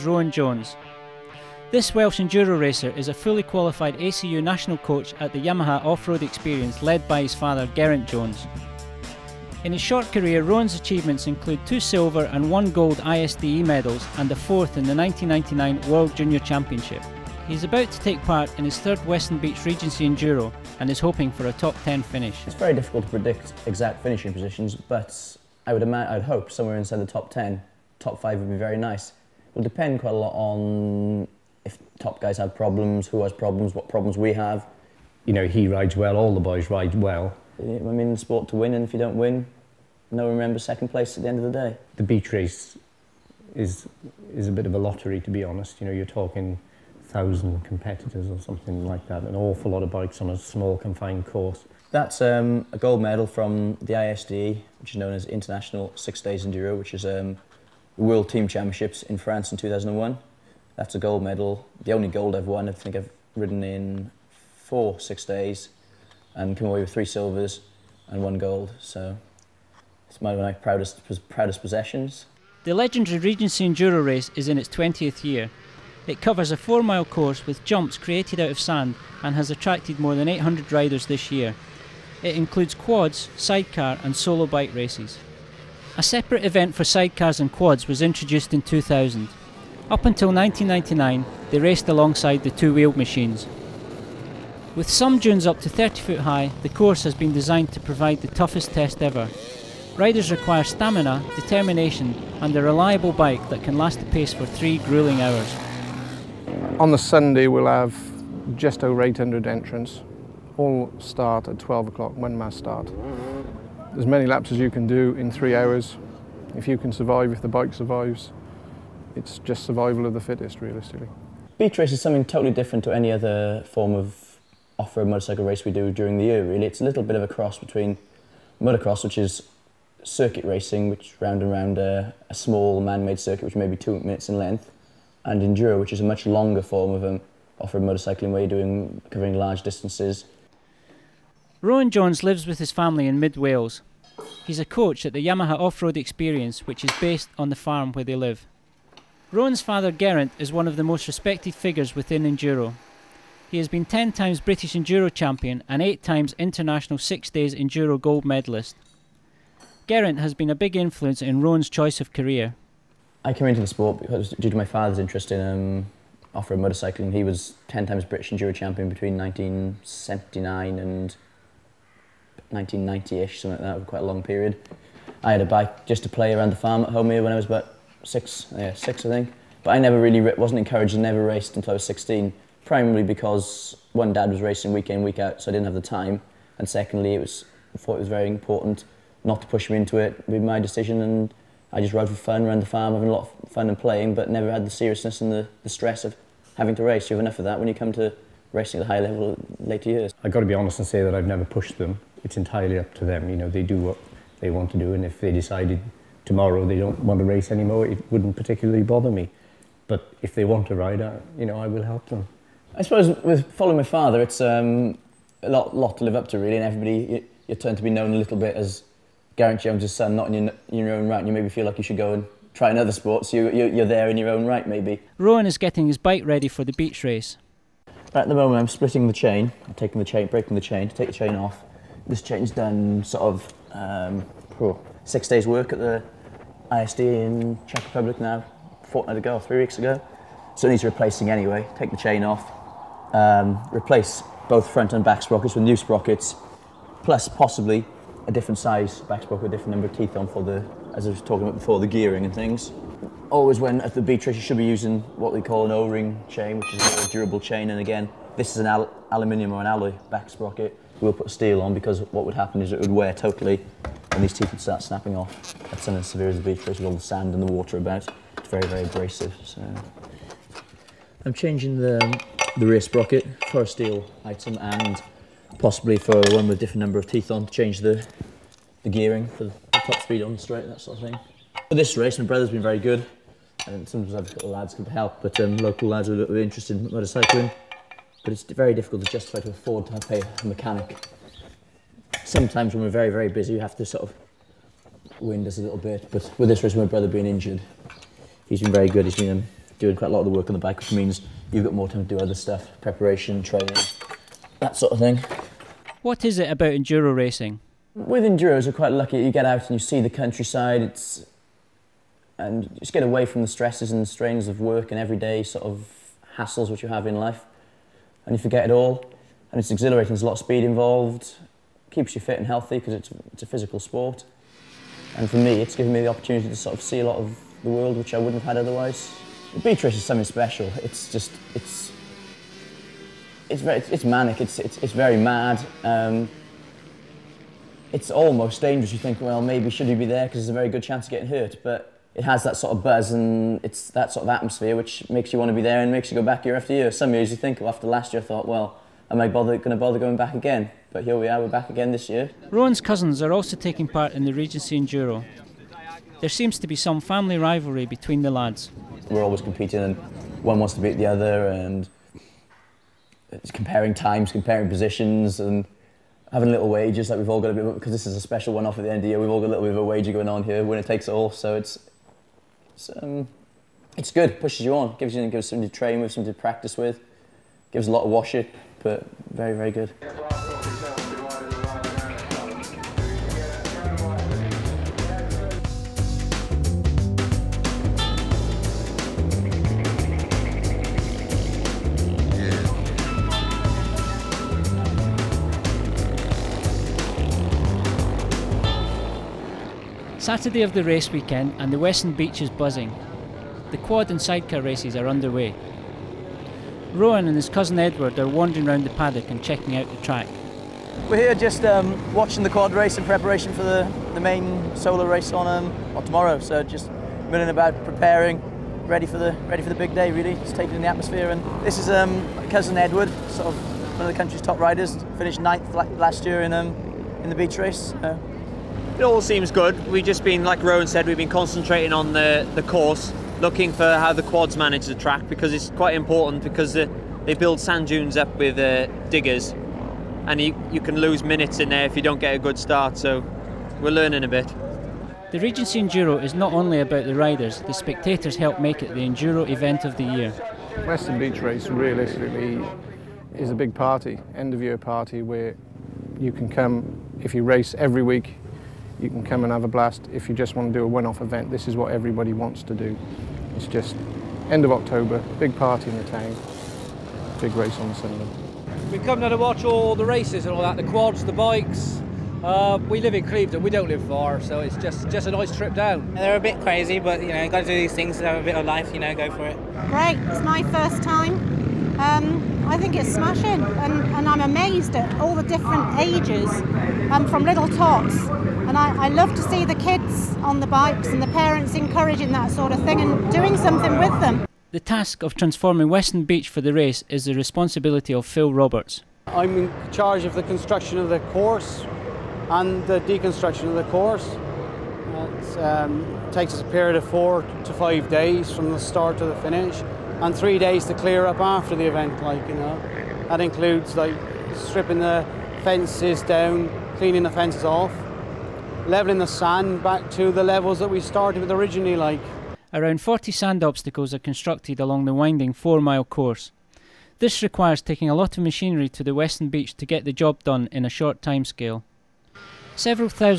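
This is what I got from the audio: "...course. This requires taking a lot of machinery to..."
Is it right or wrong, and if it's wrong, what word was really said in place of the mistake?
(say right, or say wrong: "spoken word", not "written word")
right.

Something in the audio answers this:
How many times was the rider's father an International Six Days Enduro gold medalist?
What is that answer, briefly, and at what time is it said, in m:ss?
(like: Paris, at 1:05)
8, at 2:35.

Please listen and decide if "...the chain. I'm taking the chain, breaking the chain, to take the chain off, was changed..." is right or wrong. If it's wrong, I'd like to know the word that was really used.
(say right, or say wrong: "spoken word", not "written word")
right.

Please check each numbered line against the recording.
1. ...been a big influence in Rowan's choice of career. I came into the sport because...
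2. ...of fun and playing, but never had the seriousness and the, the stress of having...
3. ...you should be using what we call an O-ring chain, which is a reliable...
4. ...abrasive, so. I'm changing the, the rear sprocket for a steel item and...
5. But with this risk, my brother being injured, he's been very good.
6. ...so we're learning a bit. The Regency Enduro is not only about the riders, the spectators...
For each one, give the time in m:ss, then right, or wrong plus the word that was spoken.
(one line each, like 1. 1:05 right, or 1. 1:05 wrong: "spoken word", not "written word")
1. 2:40 right
2. 3:13 right
3. 4:14 wrong: "durable", not "reliable"
4. 4:28 right
5. 4:56 right
6. 7:22 right.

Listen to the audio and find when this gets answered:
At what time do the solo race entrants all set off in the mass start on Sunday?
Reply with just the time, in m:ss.
1:51.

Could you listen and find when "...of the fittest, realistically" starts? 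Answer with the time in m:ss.
2:00.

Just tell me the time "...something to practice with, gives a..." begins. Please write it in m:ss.
6:16.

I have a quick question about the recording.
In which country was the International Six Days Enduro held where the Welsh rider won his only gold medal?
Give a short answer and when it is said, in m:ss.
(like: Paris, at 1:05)
France, at 0:59.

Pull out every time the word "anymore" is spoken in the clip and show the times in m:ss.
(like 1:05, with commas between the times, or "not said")
3:27.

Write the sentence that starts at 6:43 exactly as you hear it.
The quad and sidecar races are underway.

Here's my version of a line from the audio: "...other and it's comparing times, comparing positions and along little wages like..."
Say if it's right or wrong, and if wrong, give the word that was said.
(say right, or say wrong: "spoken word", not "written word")
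wrong: "having", not "along".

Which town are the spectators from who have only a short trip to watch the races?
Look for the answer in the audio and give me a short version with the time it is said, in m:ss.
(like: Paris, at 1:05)
Clevedon, at 7:53.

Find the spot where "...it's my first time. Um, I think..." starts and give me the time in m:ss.
8:00.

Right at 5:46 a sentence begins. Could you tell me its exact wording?
Some years you think, well, after last year, I thought, well, am I bother, going to bother going back again?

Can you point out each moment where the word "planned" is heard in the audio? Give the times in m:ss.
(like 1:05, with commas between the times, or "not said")
not said.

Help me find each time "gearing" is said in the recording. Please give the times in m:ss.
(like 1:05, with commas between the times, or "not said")
4:11, 4:38.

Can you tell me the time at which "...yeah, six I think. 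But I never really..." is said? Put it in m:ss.
2:58.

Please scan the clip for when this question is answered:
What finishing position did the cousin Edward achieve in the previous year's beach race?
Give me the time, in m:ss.
7:05.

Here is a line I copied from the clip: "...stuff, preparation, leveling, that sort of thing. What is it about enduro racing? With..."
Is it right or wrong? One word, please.
wrong.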